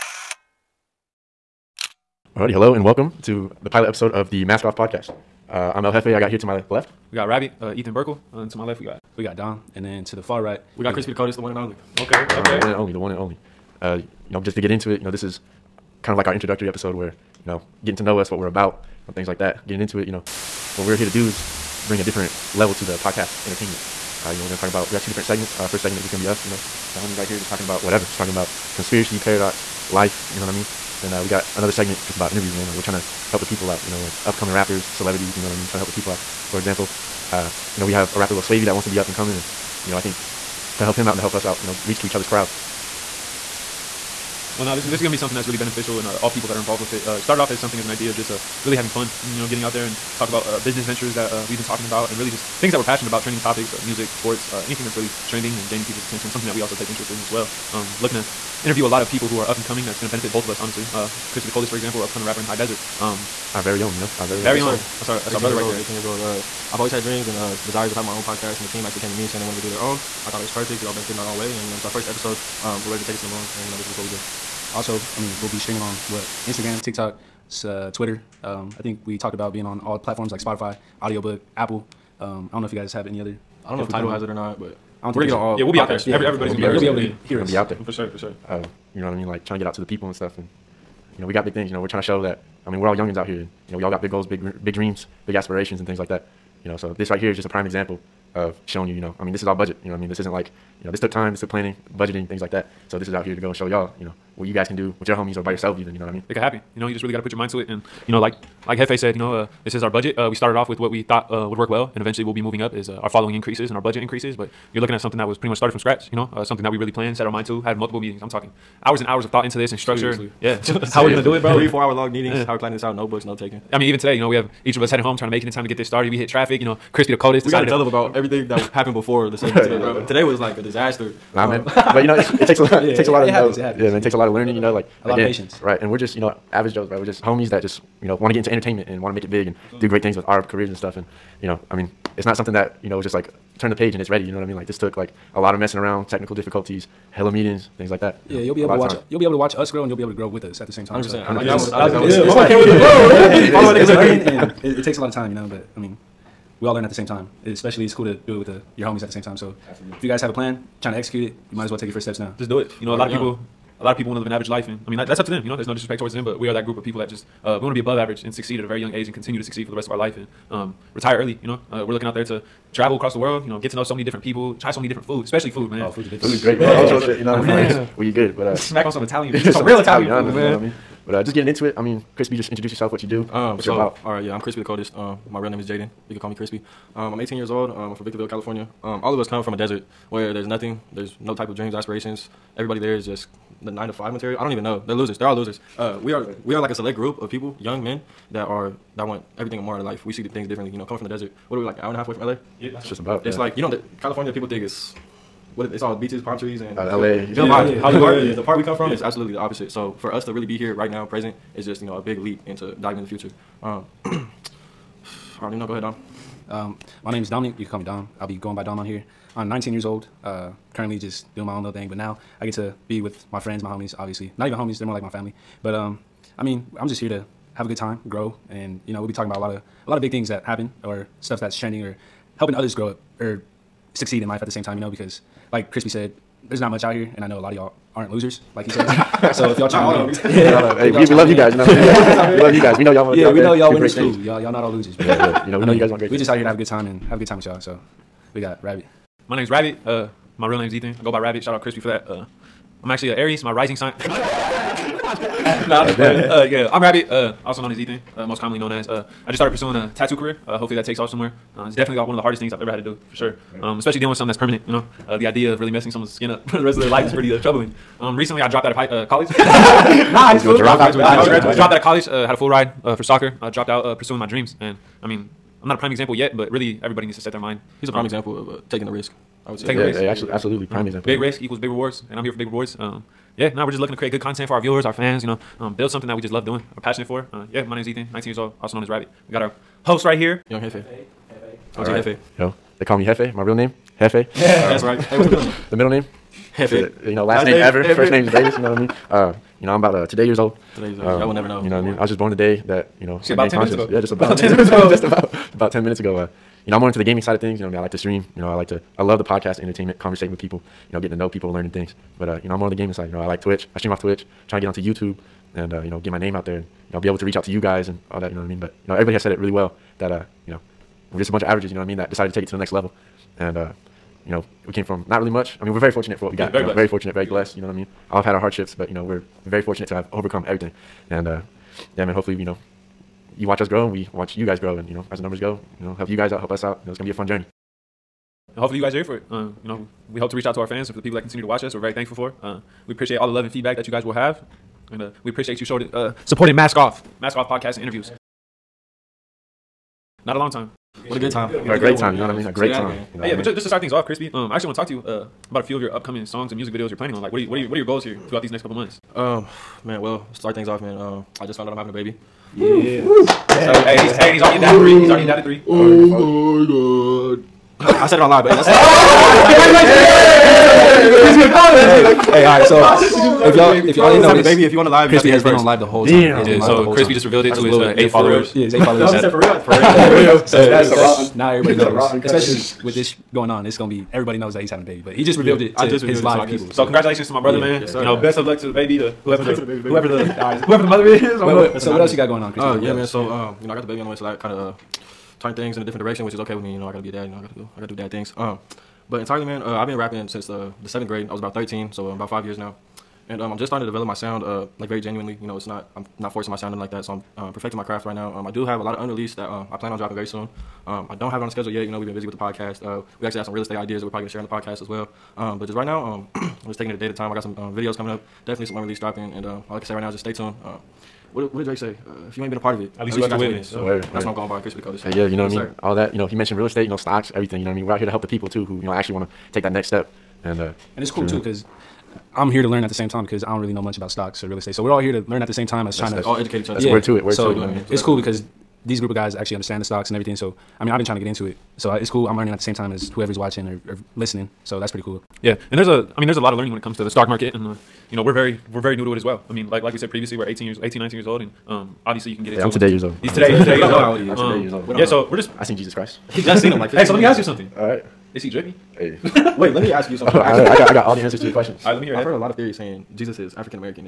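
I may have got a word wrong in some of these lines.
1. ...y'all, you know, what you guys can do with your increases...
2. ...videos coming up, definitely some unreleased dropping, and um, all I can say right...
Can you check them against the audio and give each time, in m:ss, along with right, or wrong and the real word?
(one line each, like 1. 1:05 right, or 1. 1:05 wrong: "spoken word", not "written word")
1. 1:43 wrong: "homies", not "increases"
2. 6:57 right.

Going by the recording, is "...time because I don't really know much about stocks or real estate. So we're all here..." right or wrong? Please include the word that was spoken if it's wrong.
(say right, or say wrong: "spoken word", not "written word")
right.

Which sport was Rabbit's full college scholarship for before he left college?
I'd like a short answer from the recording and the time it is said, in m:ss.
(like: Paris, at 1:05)
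Soccer, at 4:33.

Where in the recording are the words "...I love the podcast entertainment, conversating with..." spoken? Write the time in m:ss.
5:08.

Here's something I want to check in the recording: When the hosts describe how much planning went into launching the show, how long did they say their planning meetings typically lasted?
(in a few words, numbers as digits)
3 to 4 hours.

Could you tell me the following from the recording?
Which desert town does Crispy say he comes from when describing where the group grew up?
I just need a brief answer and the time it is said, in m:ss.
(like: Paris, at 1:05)
Victorville, California, at 3:08.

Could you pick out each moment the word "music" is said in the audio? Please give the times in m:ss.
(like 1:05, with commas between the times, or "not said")
0:53, 5:56.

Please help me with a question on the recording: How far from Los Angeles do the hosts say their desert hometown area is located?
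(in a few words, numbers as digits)
An hour and a half.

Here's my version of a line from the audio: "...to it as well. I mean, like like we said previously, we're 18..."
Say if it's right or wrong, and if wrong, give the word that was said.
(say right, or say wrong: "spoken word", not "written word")
right.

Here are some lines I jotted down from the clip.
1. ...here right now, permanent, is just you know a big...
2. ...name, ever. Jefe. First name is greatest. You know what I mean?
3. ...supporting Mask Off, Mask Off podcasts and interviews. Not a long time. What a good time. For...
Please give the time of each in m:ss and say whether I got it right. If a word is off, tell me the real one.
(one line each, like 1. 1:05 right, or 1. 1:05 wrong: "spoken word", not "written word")
1. 3:30 wrong: "present", not "permanent"
2. 4:57 right
3. 5:46 right.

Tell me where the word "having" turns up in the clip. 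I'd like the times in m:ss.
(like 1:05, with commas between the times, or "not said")
0:48, 1:07, 6:01, 6:24.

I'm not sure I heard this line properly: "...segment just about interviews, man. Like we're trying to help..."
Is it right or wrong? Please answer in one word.
right.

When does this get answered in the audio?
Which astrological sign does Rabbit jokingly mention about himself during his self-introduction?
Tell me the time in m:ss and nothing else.
4:13.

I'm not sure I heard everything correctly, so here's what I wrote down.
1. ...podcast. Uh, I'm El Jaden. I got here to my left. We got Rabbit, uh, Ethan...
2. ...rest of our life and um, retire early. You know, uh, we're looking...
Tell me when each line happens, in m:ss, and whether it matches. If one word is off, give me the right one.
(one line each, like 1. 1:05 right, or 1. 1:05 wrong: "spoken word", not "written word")
1. 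0:04 wrong: "Jefe", not "Jaden"
2. 2:49 right.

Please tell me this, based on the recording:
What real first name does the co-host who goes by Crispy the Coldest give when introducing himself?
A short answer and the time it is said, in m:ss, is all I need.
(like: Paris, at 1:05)
Jaden, at 3:05.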